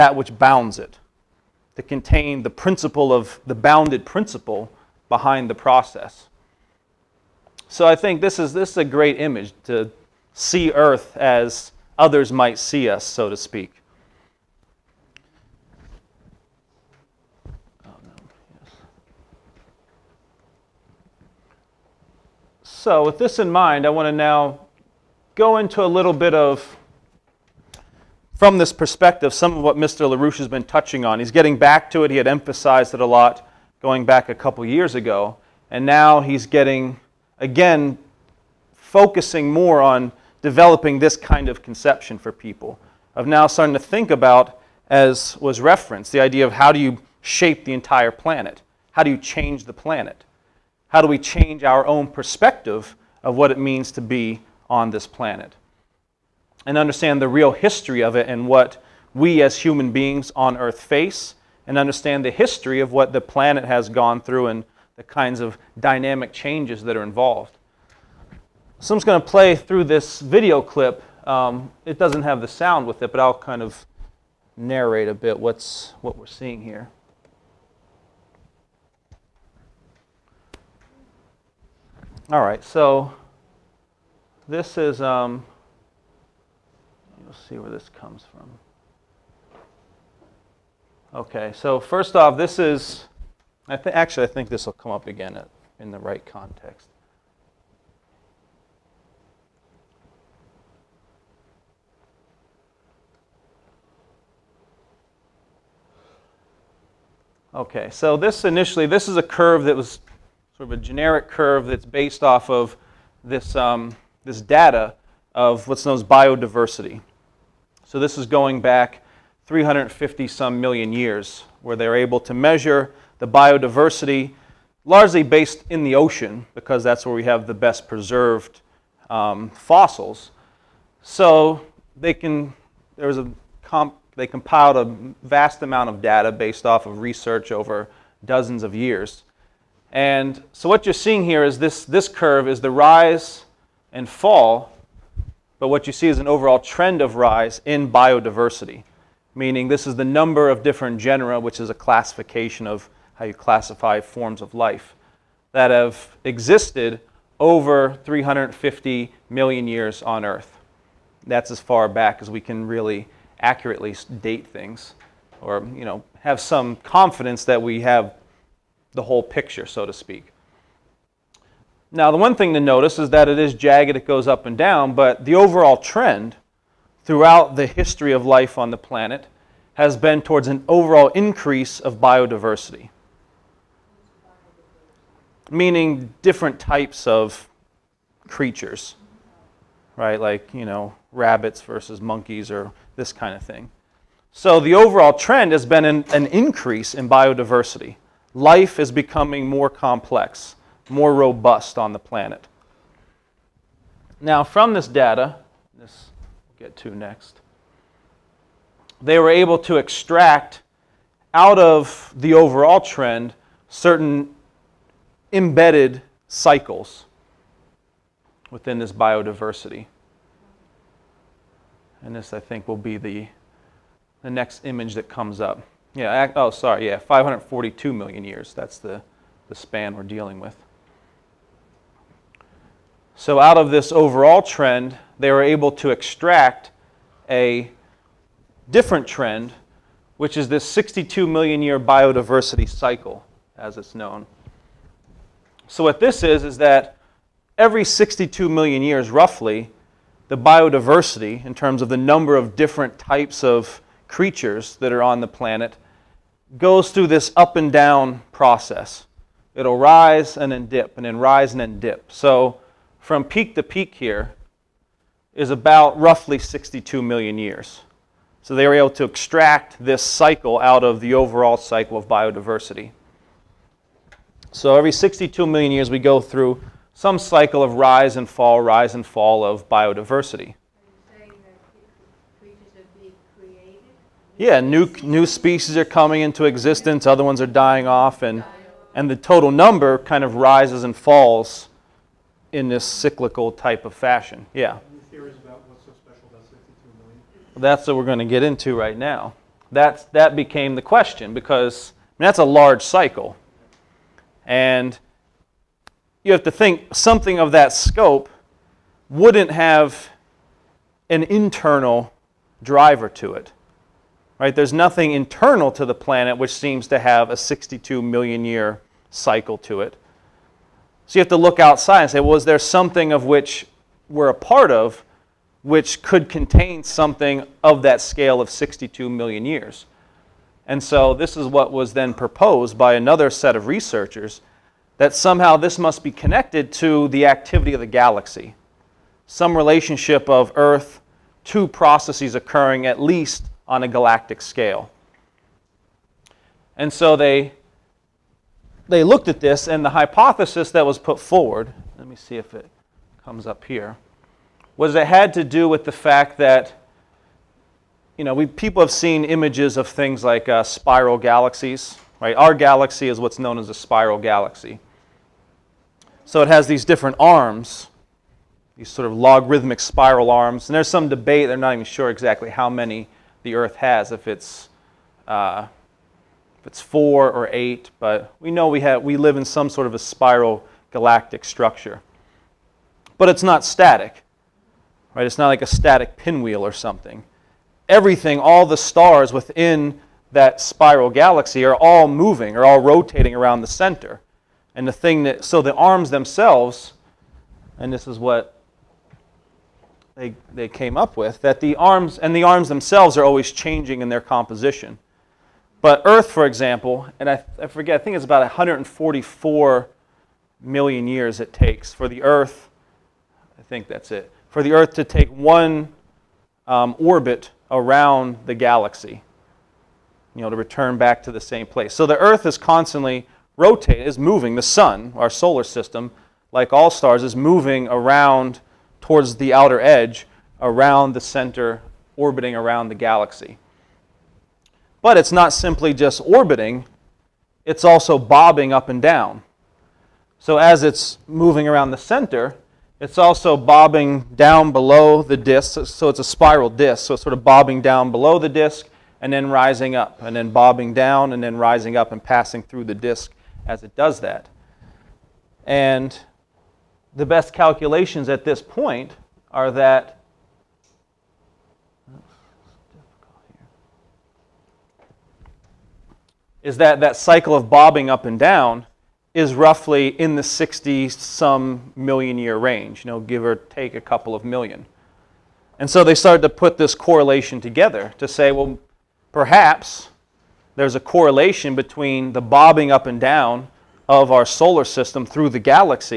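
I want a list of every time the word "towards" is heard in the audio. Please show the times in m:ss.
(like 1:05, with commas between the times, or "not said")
3:00, 7:09.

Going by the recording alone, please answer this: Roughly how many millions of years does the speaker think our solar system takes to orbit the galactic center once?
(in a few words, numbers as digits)
144 million years.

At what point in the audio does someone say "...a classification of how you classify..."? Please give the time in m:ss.
2:31.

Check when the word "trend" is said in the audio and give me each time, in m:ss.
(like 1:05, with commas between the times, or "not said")
2:26, 2:55, 3:15, 3:32, 3:54, 3:59.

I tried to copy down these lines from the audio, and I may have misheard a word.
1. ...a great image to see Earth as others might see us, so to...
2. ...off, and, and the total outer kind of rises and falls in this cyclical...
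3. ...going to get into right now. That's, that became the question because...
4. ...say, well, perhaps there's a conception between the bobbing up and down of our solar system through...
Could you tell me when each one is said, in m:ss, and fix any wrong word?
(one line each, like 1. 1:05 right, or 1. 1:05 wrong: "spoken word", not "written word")
1. 0:08 right
2. 4:47 wrong: "number", not "outer"
3. 4:58 right
4. 7:58 wrong: "correlation", not "conception".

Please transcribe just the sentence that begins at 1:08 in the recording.
So I'm just going to play through this video clip.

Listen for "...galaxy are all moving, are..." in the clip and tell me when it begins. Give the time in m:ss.
6:31.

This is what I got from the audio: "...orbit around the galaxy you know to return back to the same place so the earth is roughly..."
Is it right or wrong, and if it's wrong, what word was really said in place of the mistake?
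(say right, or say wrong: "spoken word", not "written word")
wrong: "constantly", not "roughly".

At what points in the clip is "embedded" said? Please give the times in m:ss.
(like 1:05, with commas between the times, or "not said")
3:35.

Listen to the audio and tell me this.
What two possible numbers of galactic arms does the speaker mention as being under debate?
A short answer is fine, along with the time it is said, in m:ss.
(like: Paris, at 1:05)
4 or 8, at 6:16.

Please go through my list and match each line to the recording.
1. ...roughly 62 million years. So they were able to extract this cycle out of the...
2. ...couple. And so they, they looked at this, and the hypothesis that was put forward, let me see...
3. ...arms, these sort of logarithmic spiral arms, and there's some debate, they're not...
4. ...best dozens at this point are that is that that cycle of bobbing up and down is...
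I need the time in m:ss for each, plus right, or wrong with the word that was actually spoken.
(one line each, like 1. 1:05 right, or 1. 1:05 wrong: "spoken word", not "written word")
1. 4:25 right
2. 5:44 wrong: "scale", not "couple"
3. 6:07 right
4. 7:37 wrong: "calculations", not "dozens".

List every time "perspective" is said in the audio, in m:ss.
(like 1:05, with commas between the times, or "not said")
0:28, 0:52.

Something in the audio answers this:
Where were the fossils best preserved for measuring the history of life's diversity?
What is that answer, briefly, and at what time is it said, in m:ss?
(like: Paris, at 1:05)
the ocean, at 2:05.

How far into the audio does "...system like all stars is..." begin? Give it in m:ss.
7:05.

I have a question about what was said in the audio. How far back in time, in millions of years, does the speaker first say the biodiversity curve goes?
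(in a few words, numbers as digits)
350 million years.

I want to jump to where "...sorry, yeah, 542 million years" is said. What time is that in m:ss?
3:46.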